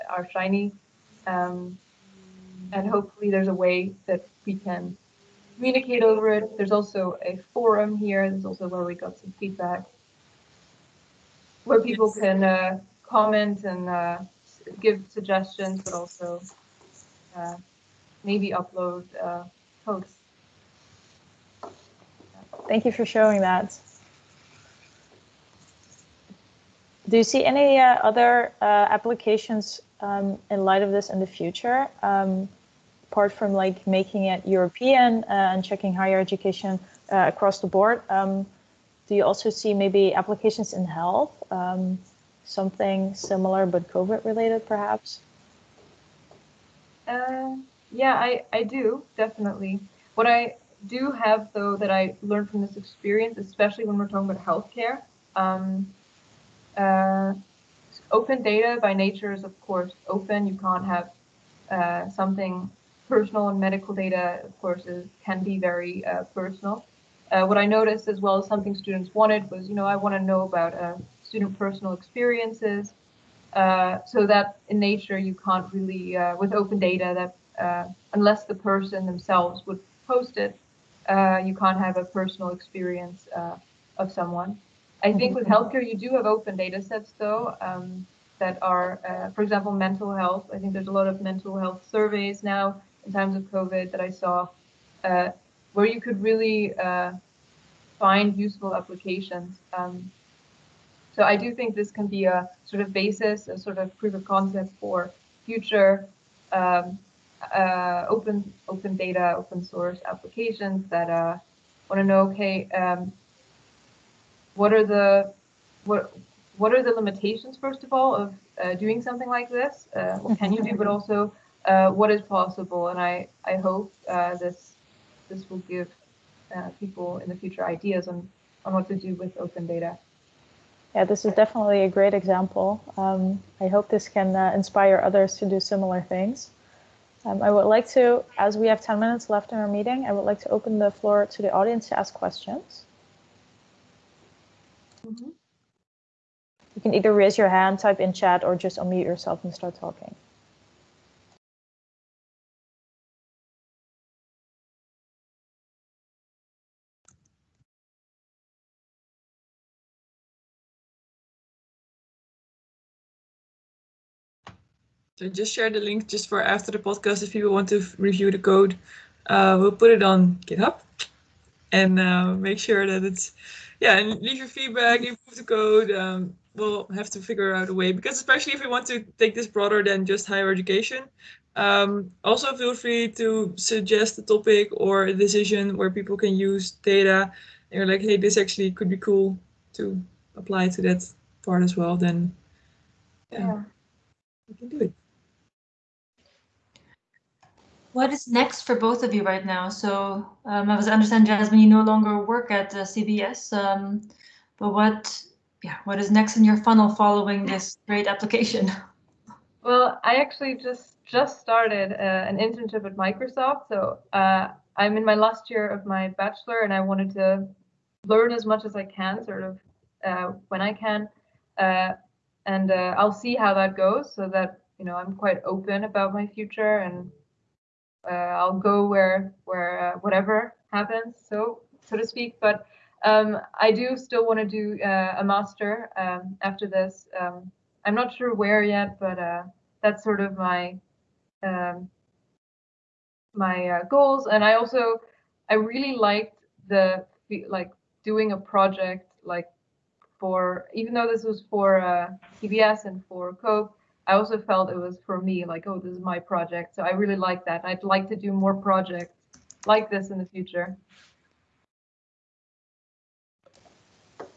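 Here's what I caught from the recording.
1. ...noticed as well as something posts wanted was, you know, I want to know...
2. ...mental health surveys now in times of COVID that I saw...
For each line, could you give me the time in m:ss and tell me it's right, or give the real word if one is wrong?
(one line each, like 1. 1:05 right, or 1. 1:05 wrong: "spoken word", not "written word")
1. 1:07 wrong: "students", not "posts"
2. 1:31 right.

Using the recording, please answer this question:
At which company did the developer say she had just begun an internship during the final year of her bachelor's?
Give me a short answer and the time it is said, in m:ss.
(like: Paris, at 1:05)
Microsoft, at 3:33.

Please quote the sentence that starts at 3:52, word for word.
But um, I do still want to do uh, a master um, after this.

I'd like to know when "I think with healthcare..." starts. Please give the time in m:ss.
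1:25.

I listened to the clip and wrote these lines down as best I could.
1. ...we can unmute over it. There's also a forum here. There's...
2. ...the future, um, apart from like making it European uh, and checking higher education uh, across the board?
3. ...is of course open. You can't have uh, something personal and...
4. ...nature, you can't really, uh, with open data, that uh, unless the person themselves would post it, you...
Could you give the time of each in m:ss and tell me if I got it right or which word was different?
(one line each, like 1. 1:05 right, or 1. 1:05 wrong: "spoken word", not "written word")
1. 0:04 wrong: "communicate", not "unmute"
2. 0:31 right
3. 0:59 right
4. 1:14 right.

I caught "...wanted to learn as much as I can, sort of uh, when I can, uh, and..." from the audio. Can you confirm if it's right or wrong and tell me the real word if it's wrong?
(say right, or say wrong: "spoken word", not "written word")
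right.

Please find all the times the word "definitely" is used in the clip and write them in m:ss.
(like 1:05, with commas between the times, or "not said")
0:49, 2:11.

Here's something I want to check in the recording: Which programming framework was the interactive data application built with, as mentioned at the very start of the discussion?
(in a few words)
R Shiny.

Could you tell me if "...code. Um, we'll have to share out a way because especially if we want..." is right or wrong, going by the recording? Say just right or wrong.
wrong.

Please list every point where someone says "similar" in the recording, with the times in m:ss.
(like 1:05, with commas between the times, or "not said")
0:43, 2:15.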